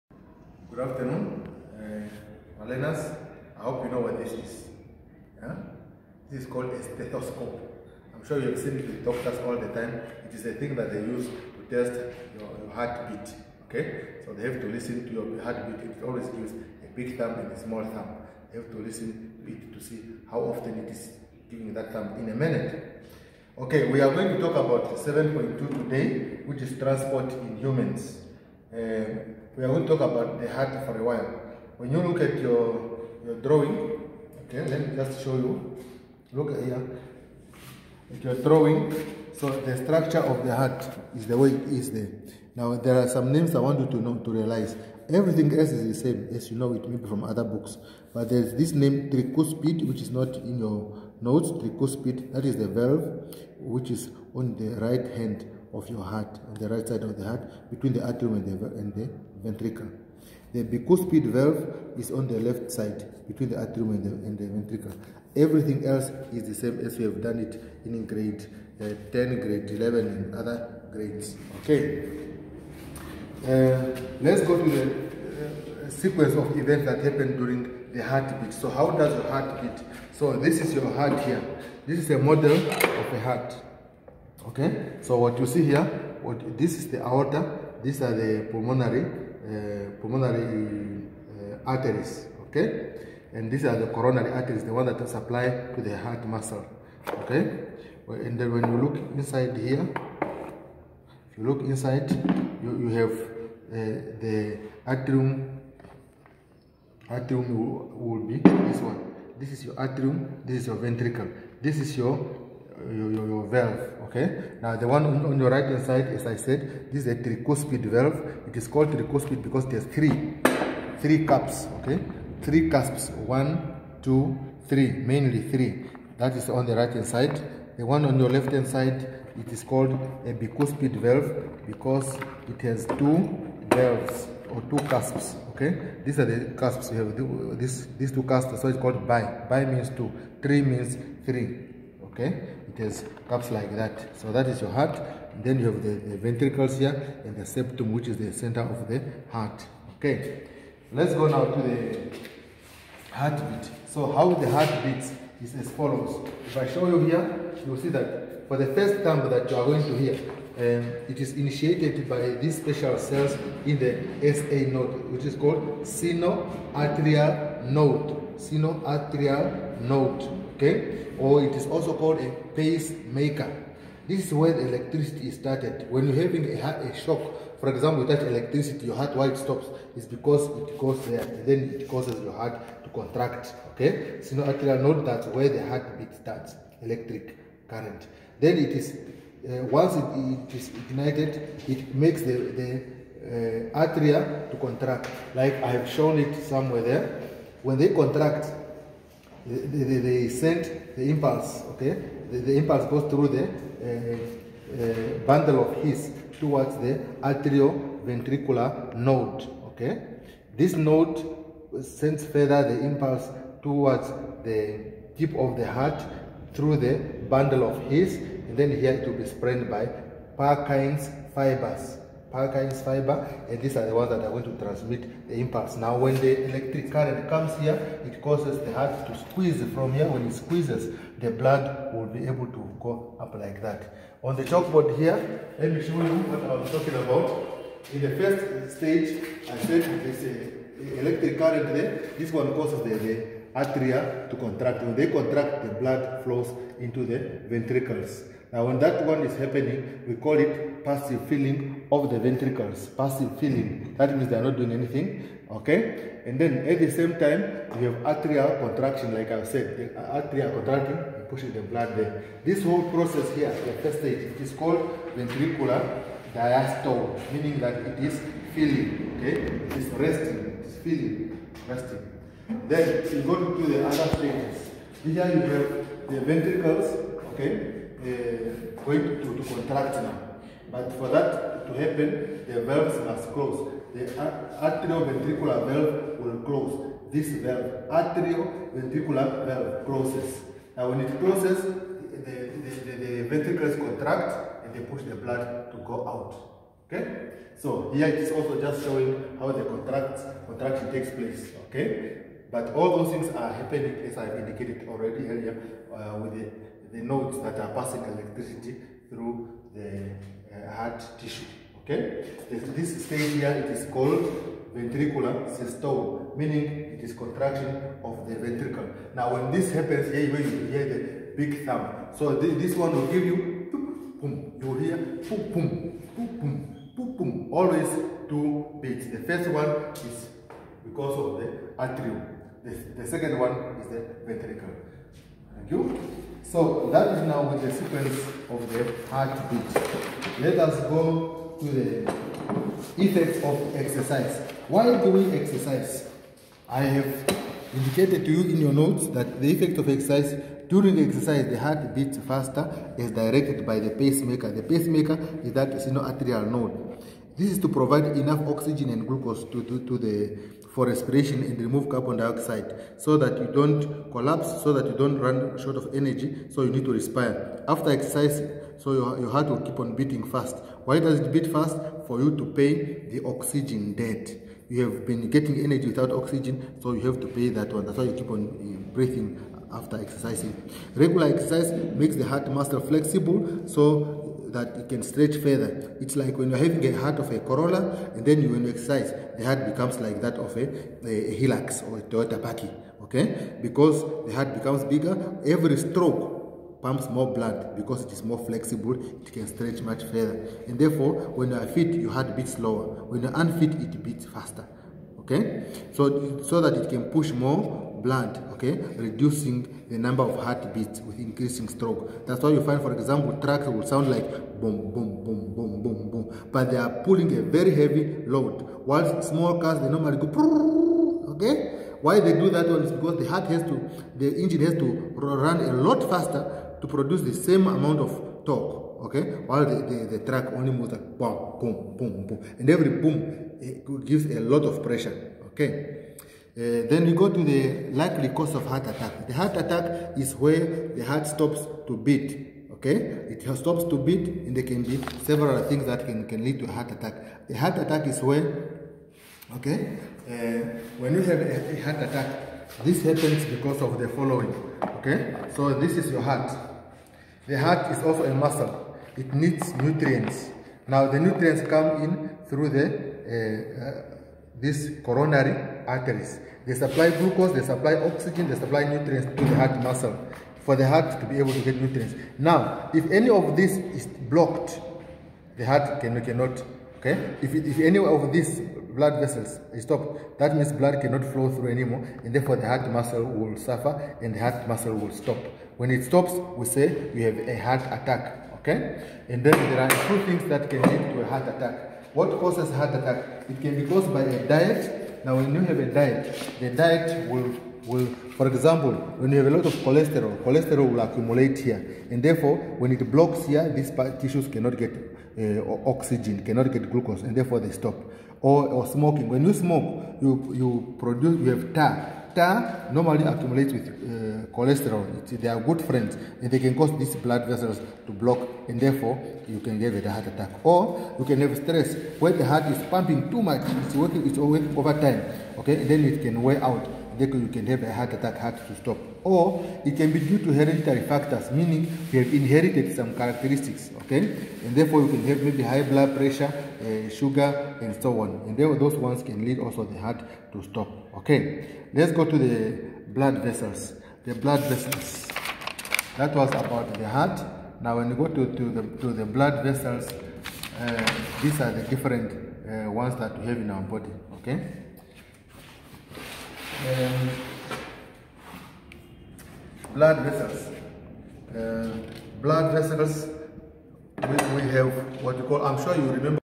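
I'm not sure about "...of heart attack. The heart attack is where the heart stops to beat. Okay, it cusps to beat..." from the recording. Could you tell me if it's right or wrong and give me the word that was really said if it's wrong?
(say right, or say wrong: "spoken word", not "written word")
wrong: "stops", not "cusps".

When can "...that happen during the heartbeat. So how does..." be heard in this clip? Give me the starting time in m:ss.
1:16.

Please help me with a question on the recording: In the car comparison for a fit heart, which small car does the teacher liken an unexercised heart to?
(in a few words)
Corolla.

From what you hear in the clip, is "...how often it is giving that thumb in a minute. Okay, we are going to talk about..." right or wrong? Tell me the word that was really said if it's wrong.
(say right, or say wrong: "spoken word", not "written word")
right.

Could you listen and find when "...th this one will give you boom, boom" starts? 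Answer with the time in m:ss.
5:22.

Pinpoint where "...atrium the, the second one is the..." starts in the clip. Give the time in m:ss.
5:31.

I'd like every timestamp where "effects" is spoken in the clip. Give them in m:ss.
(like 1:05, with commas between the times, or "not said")
5:43, 5:49.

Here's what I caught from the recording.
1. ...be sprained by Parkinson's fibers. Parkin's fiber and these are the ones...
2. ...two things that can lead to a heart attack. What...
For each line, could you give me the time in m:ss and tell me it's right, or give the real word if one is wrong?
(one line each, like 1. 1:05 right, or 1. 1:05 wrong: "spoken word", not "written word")
1. 3:39 right
2. 8:10 right.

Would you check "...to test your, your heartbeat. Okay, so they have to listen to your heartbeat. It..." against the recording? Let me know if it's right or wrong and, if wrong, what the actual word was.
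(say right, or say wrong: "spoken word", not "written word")
right.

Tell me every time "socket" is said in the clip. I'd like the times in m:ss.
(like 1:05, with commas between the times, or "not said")
not said.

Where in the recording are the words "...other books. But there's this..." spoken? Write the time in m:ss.
0:47.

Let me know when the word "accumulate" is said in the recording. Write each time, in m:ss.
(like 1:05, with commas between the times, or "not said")
8:20, 8:33.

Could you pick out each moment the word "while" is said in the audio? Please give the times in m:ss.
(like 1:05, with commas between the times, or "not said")
0:31, 6:58, 7:09.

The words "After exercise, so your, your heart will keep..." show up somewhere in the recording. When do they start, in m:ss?
6:07.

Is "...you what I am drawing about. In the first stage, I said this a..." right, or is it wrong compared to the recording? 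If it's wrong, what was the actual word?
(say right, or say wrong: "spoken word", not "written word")
wrong: "talking", not "drawing".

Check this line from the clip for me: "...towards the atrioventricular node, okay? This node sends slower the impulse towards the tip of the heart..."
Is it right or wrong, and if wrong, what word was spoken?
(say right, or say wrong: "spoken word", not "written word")
wrong: "further", not "slower".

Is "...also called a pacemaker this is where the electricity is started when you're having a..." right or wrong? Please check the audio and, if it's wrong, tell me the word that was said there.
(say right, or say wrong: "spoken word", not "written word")
right.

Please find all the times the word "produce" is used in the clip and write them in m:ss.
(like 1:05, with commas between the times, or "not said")
7:06, 8:30.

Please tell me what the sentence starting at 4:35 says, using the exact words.
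Here you have the ventricles, okay, uh, going to, to contract now.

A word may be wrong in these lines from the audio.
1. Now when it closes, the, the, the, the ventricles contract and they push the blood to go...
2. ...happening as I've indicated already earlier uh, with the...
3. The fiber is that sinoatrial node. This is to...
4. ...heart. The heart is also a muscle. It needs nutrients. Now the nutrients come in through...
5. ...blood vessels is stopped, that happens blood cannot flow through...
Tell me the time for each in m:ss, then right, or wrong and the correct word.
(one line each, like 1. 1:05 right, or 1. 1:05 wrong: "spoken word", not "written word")
1. 4:50 right
2. 5:03 right
3. 5:54 wrong: "pacemaker", not "fiber"
4. 7:36 right
5. 7:58 wrong: "means", not "happens".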